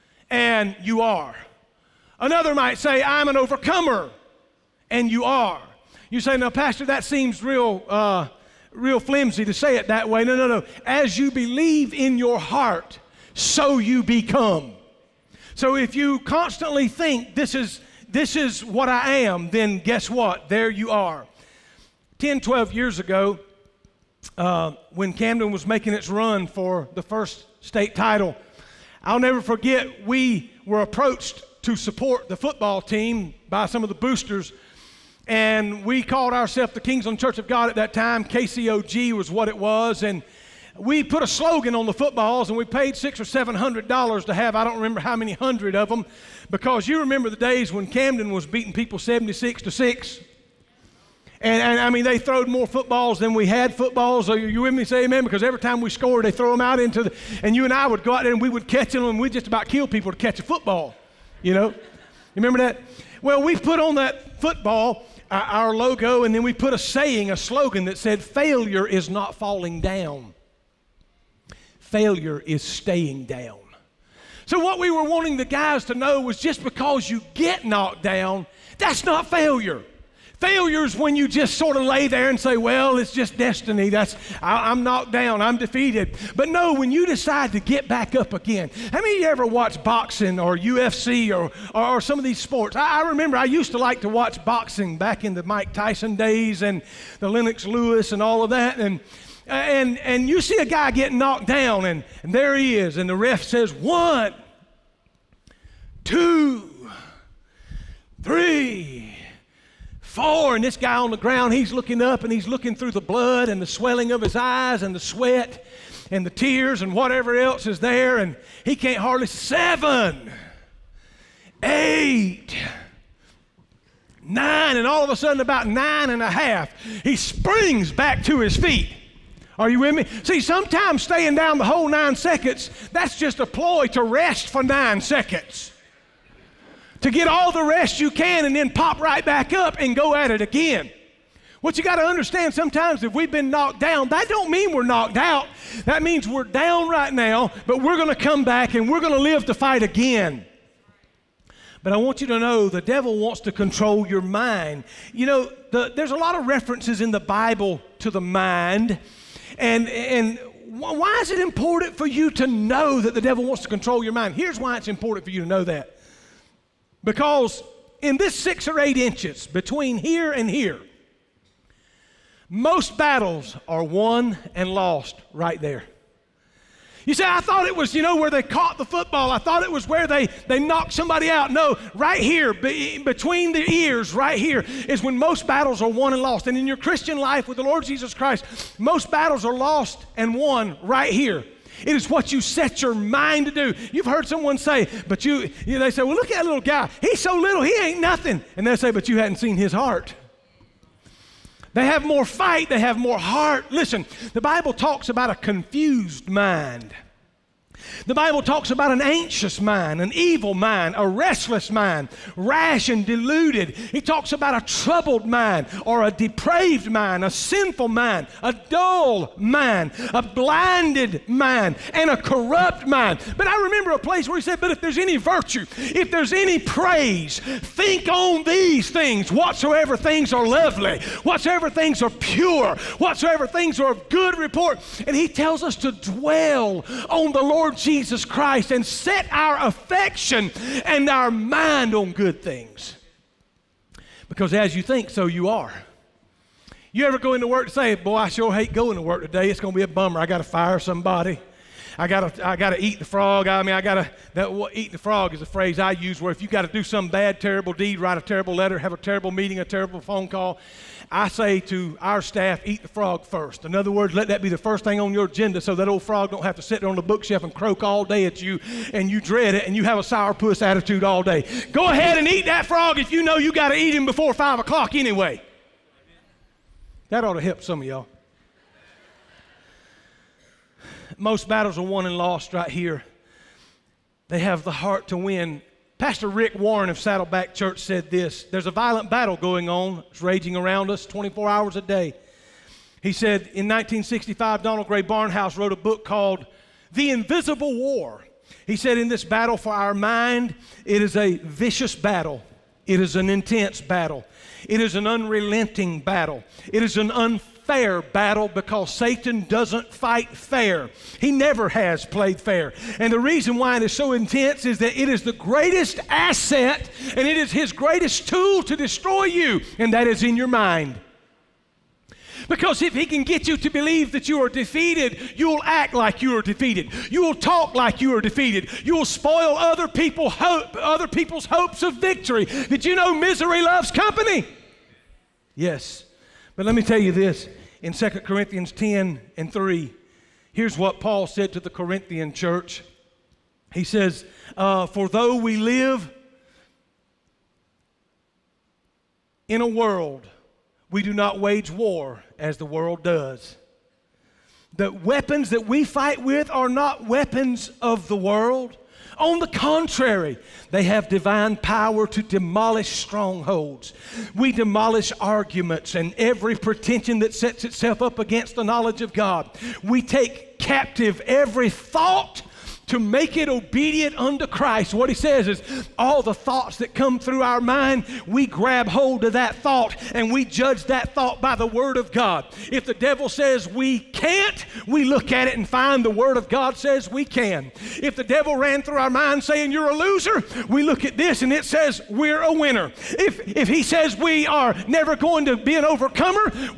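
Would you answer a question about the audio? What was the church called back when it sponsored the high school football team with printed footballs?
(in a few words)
Kingsland Church of God.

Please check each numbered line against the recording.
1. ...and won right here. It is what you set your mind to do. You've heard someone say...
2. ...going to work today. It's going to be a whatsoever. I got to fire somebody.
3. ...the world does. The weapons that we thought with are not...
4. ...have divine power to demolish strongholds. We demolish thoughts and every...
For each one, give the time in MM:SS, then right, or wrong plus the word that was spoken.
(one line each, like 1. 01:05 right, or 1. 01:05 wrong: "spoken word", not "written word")
1. 03:10 right
2. 04:08 wrong: "bummer", not "whatsoever"
3. 05:52 wrong: "fight", not "thought"
4. 06:00 wrong: "arguments", not "thoughts".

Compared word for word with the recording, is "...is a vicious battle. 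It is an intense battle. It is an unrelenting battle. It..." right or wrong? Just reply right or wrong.
right.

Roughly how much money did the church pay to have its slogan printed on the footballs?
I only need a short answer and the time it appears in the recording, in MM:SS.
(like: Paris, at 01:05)
six or seven hundred dollars, at 00:42.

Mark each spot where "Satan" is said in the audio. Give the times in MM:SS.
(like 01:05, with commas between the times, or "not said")
05:08.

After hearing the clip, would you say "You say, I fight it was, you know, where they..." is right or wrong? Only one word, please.
wrong.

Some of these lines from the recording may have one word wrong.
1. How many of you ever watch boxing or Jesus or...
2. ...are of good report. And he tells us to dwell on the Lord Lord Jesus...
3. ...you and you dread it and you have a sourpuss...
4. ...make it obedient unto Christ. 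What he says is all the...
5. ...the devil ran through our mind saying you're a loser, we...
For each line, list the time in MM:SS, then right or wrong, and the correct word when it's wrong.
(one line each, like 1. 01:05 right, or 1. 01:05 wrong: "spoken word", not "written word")
1. 01:28 wrong: "UFC", not "Jesus"
2. 03:53 right
3. 04:28 right
4. 06:12 right
5. 06:28 right.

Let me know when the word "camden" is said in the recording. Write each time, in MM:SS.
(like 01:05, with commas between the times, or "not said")
00:25, 00:47.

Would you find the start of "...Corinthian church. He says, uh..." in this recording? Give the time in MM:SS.
05:41.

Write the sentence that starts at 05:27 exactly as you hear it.
You'll talk like you are defeated.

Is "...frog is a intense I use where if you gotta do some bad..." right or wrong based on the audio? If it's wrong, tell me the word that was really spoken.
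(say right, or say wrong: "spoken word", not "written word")
wrong: "phrase", not "intense".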